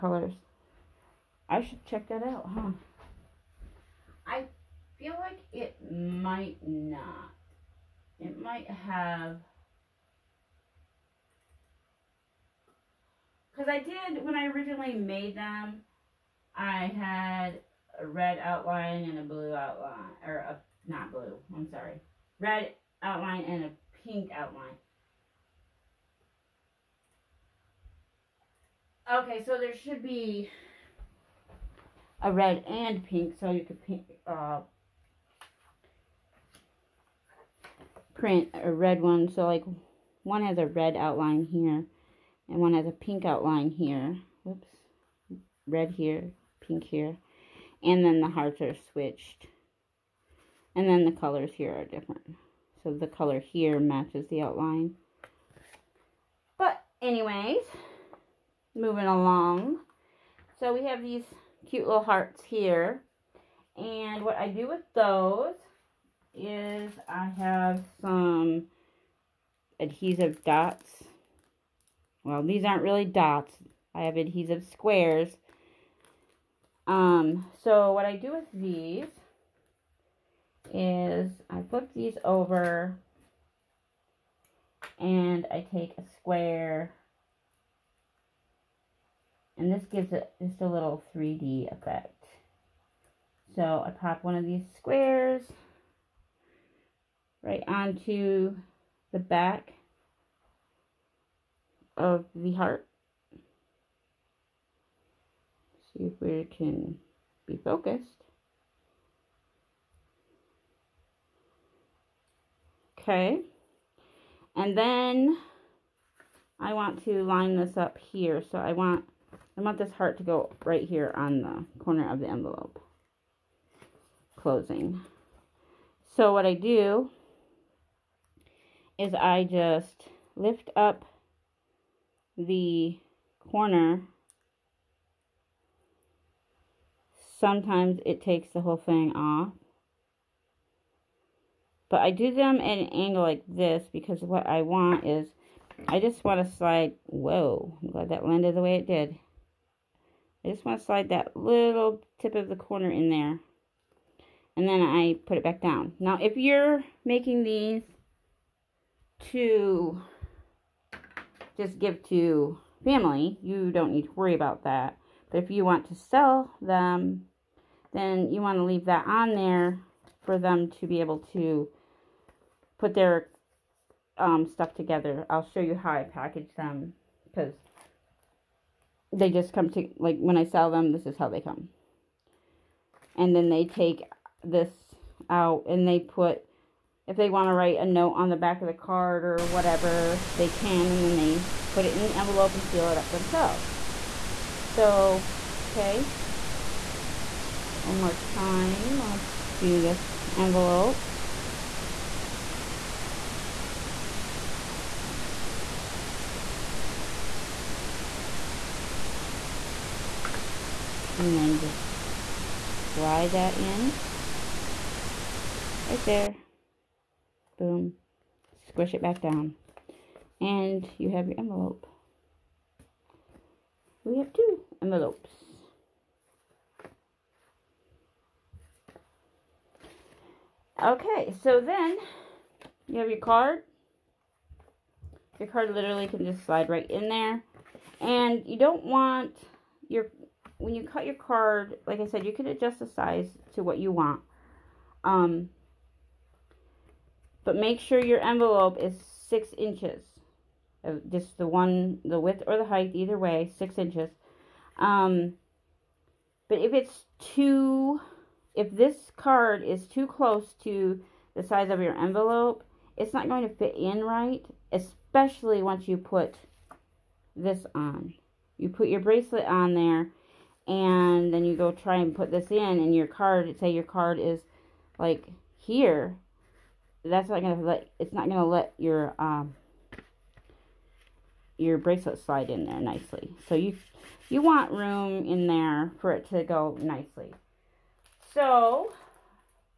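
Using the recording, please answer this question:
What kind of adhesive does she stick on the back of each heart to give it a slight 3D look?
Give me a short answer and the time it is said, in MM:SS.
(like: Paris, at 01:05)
Adhesive squares, at 01:14.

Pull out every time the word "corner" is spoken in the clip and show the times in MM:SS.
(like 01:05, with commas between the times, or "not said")
02:01, 02:13, 02:32.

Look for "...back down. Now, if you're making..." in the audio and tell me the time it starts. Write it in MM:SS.
02:35.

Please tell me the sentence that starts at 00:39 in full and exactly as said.
So, like, one has a red outline here, and one has a pink outline here.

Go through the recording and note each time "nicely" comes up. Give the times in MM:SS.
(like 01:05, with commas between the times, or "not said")
04:42, 04:46.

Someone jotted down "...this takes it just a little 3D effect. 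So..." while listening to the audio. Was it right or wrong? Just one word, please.
wrong.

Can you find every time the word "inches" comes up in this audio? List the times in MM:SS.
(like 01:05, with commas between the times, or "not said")
04:09, 04:13.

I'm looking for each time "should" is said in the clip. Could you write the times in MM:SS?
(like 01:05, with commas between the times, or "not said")
00:01, 00:29.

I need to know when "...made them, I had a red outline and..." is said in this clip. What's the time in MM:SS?
00:14.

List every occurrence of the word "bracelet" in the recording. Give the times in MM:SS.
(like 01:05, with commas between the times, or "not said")
04:29, 04:41.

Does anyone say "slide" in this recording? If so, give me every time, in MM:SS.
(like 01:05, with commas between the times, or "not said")
02:26, 02:30, 03:32, 03:56, 04:42.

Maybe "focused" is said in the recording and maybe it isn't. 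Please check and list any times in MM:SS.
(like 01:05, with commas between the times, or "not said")
01:47.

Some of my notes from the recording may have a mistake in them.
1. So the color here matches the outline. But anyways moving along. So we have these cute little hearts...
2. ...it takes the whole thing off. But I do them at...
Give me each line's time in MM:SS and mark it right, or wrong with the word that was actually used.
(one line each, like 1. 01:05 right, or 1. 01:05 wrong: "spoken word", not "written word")
1. 00:52 right
2. 02:18 right.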